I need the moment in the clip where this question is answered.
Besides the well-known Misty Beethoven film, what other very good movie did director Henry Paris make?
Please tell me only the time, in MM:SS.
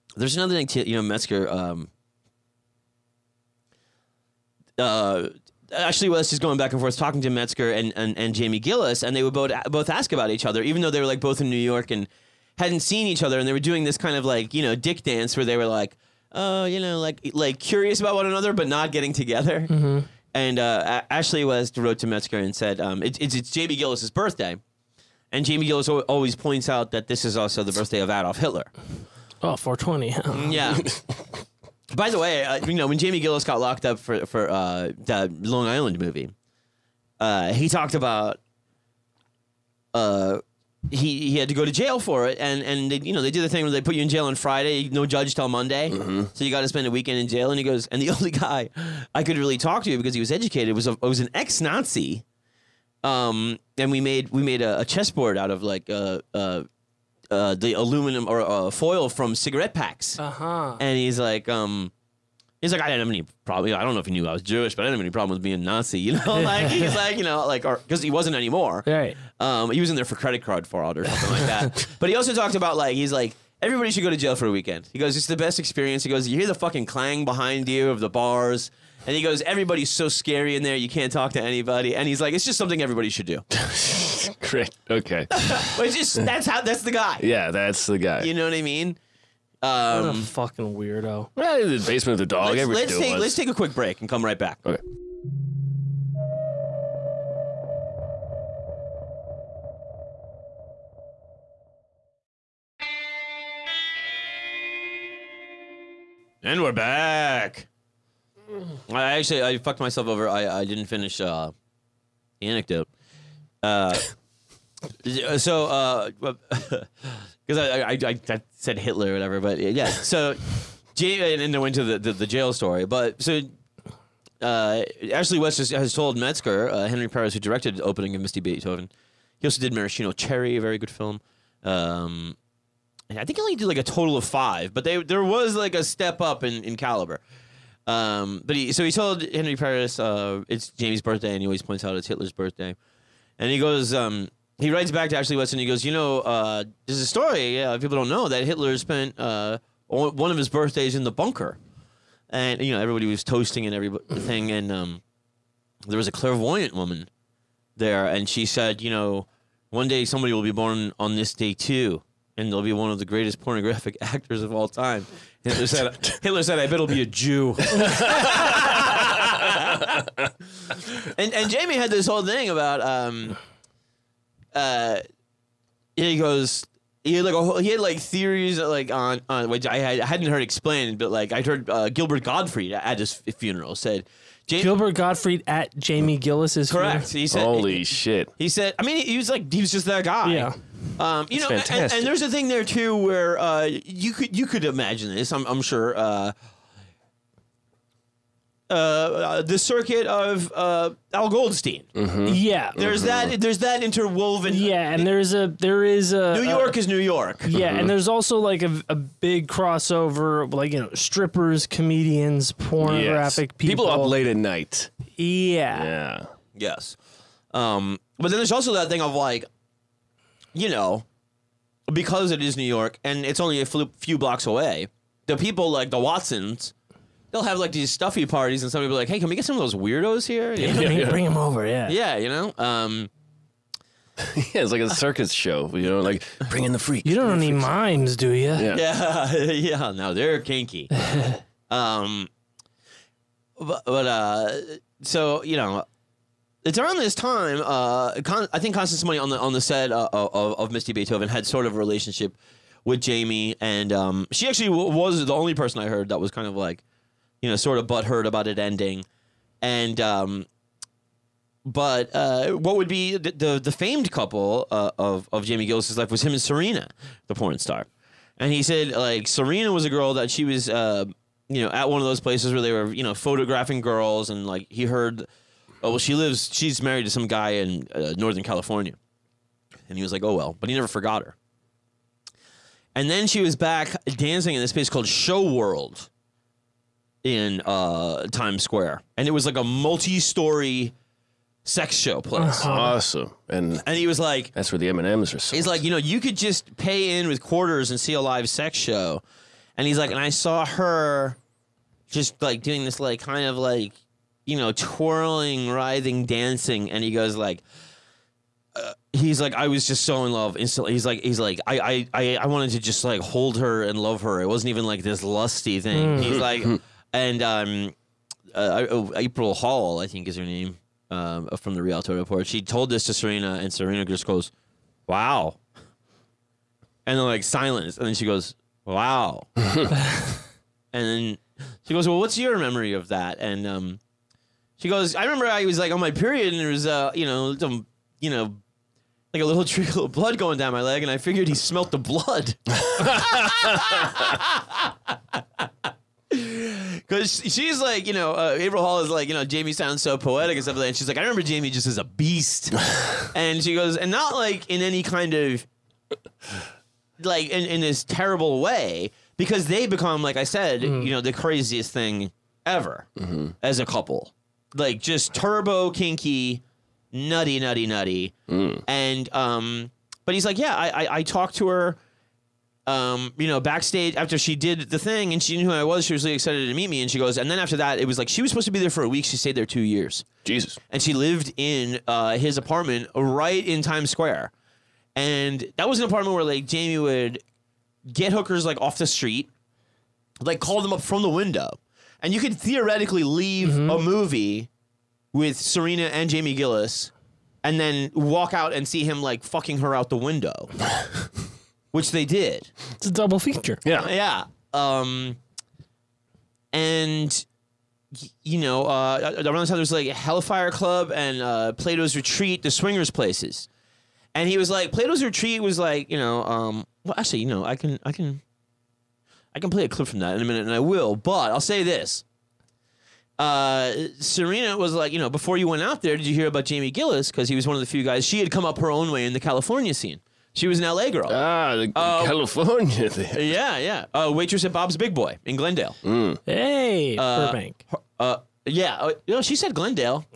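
02:09.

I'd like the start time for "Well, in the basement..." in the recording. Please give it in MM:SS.
01:31.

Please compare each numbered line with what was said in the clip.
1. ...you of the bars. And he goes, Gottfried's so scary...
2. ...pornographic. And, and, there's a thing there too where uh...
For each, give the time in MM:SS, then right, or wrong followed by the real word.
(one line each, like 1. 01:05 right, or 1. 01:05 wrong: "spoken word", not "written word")
1. 01:17 wrong: "Everybody", not "Gottfried"
2. 03:11 wrong: "fantastic", not "pornographic".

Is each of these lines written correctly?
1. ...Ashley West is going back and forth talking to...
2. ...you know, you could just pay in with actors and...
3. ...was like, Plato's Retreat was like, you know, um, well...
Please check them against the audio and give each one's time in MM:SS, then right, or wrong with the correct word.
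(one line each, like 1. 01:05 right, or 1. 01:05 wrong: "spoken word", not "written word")
1. 00:05 right
2. 04:55 wrong: "quarters", not "actors"
3. 06:54 right.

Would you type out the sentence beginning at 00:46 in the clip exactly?
so you got to spend a weekend in jail.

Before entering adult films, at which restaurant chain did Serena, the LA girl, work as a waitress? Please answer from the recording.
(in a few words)
Bob's Big Boy.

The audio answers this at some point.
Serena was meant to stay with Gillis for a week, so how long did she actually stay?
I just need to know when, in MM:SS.
06:19.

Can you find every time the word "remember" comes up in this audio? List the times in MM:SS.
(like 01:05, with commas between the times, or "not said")
05:35, 05:51.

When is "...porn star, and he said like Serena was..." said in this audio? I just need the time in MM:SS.
04:27.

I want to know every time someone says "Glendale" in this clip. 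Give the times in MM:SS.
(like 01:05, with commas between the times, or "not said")
07:15, 07:19.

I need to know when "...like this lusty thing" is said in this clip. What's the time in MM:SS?
05:14.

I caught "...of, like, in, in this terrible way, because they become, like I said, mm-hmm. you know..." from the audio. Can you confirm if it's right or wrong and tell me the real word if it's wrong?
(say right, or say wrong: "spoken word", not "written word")
right.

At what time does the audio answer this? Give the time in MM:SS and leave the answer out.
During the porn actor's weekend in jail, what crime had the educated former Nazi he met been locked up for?
01:10.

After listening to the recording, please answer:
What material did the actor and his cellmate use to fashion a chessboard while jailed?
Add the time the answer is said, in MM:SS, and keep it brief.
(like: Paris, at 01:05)
foil from cigarette packs, at 00:58.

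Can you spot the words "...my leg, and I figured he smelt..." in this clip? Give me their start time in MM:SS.
05:40.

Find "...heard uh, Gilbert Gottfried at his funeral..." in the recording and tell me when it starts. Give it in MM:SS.
03:01.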